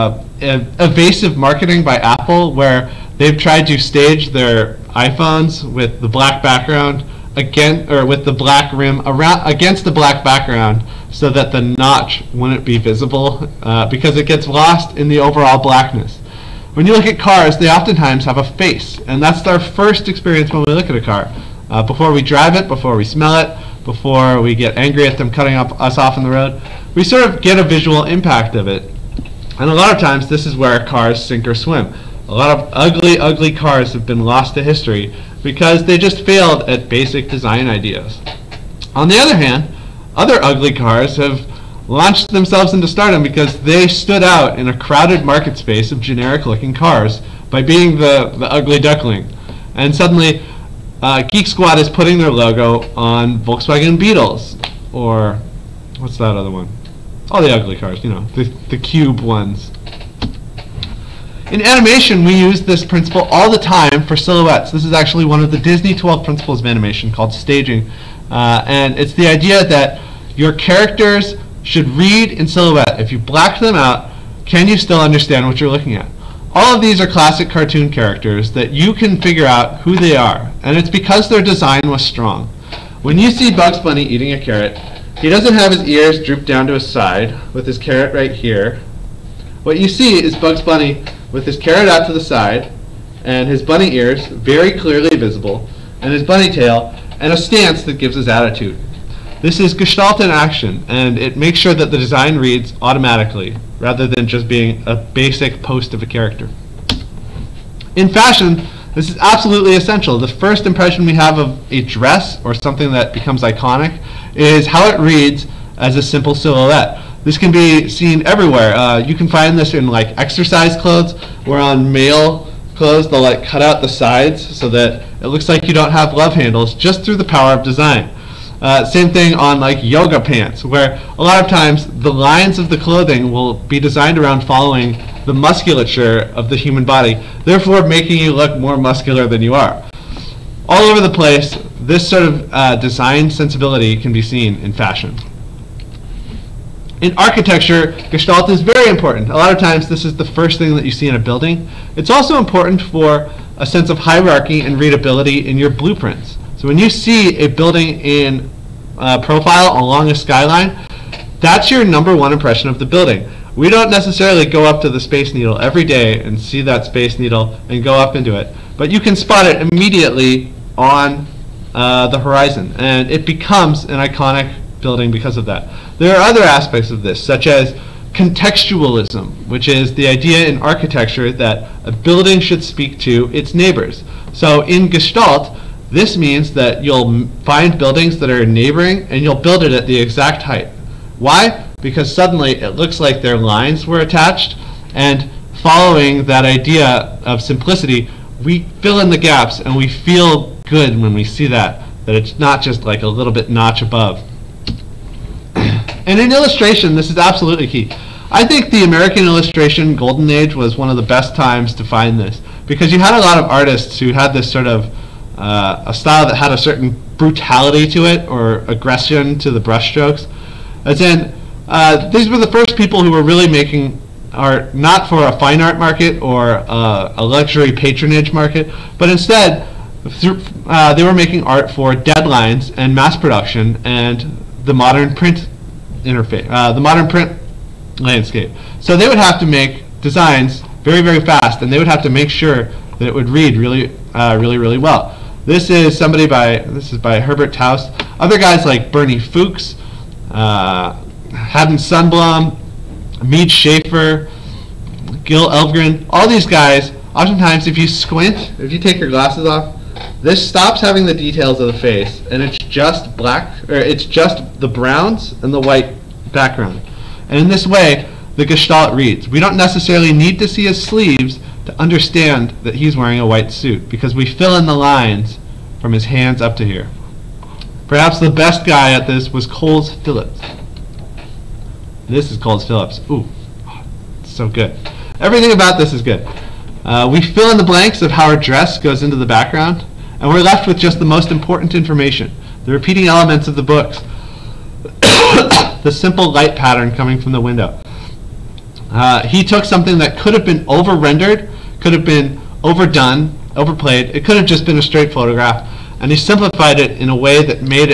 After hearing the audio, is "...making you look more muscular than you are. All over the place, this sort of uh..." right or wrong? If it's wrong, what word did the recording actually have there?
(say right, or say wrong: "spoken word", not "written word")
right.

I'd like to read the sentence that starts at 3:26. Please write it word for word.
And in illustration, this is absolutely key.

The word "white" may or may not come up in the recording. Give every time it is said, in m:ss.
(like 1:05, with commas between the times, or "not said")
4:25, 4:33.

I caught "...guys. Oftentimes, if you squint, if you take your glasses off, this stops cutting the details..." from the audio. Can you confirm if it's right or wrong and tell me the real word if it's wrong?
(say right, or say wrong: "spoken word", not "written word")
wrong: "having", not "cutting".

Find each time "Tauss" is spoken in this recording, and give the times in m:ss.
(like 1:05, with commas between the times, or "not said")
4:07.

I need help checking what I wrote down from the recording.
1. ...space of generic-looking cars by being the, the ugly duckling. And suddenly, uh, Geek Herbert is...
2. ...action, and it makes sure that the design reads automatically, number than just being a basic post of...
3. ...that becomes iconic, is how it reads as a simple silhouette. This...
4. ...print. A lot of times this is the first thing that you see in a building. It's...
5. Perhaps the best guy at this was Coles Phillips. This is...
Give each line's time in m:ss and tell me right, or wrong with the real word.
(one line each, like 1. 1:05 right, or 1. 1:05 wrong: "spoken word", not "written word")
1. 0:45 wrong: "Squad", not "Herbert"
2. 1:40 wrong: "rather", not "number"
3. 1:52 right
4. 2:28 wrong: "important", not "print"
5. 4:37 right.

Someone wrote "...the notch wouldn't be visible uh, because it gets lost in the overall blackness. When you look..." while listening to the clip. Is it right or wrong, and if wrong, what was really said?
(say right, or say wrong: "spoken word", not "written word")
right.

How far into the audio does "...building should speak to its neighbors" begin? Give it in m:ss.
3:01.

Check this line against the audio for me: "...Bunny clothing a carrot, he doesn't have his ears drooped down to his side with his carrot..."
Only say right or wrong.
wrong.